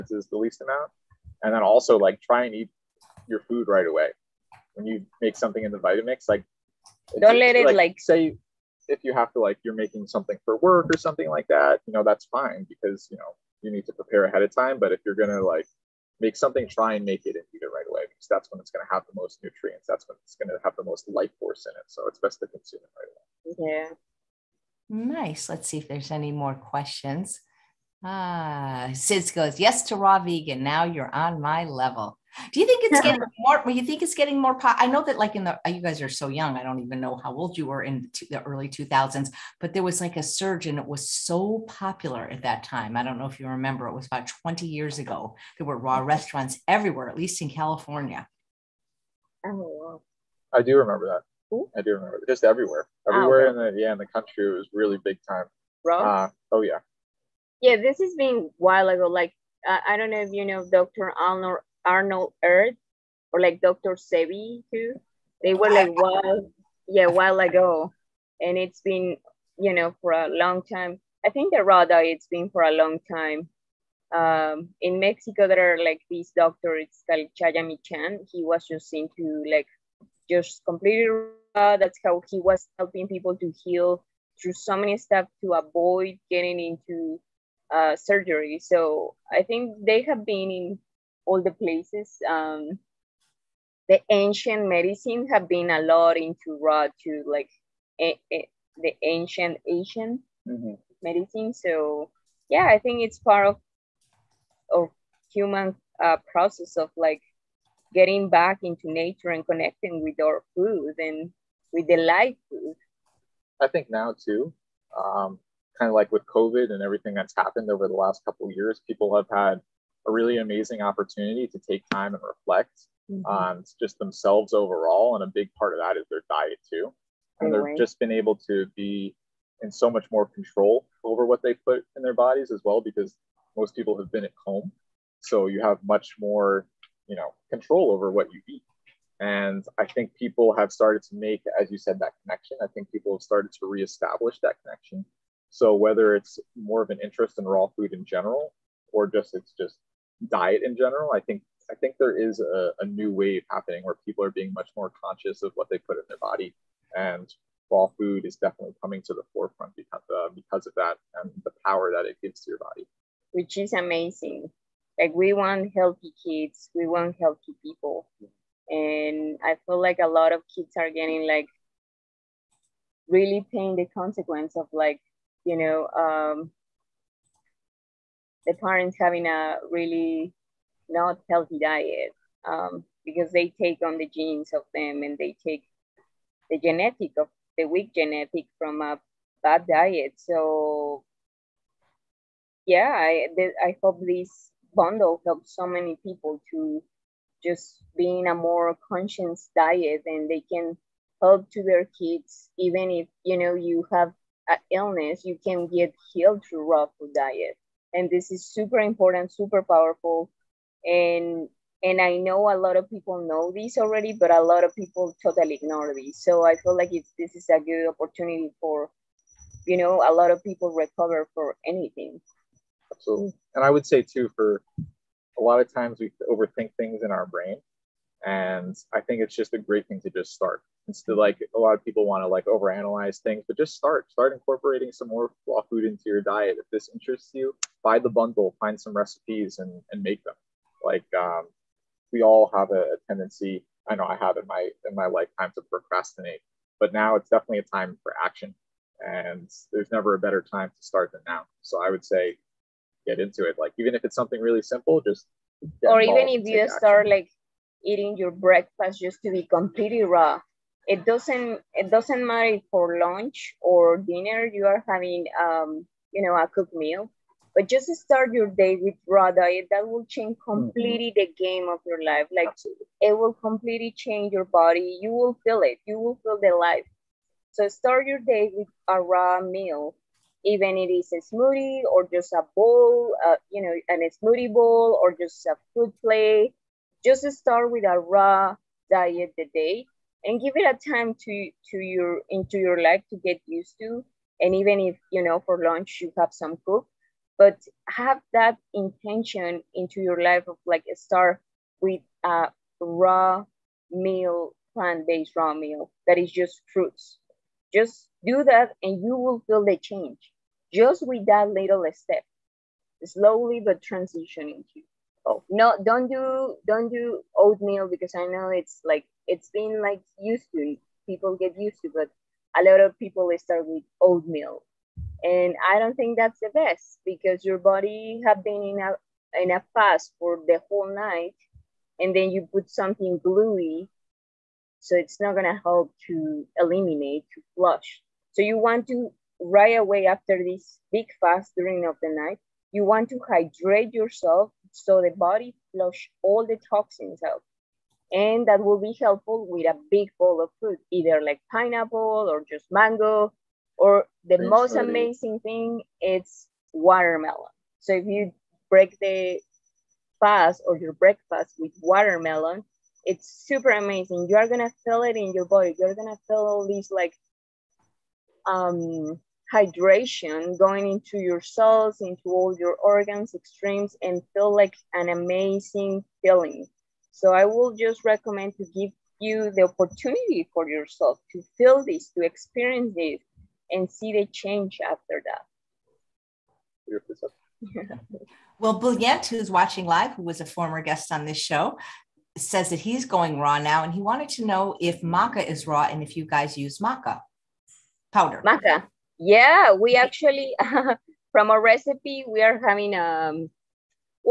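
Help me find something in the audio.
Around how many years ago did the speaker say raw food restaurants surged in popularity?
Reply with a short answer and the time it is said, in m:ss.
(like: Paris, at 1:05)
20 years, at 0:44.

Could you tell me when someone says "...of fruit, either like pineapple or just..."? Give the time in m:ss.
5:50.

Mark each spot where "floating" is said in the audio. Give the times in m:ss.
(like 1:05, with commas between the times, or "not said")
not said.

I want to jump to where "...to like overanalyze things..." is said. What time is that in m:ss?
3:52.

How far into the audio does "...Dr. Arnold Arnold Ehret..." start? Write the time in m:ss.
1:00.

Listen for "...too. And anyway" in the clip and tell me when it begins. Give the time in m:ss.
2:06.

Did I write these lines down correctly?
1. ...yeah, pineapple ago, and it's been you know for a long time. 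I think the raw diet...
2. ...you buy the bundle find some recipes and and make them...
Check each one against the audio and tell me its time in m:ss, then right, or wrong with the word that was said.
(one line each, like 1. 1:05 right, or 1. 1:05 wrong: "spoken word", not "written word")
1. 1:06 wrong: "while", not "pineapple"
2. 3:57 right.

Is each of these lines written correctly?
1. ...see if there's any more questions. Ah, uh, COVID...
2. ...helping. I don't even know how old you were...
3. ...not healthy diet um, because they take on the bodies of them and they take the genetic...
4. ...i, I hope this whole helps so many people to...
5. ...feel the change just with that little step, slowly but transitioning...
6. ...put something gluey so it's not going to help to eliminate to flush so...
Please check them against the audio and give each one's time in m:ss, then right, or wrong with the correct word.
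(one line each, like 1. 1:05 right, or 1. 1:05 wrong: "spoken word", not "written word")
1. 0:25 wrong: "Sid", not "COVID"
2. 0:36 wrong: "young", not "helping"
3. 3:00 wrong: "genes", not "bodies"
4. 3:12 wrong: "bundle", not "whole"
5. 5:09 right
6. 5:32 right.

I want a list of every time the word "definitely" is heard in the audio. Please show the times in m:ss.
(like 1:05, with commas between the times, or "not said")
2:38, 4:07.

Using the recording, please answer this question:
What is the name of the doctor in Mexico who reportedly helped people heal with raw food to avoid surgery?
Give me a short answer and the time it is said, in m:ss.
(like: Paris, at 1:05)
Chayamichan, at 1:17.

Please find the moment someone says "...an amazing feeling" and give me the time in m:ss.
6:14.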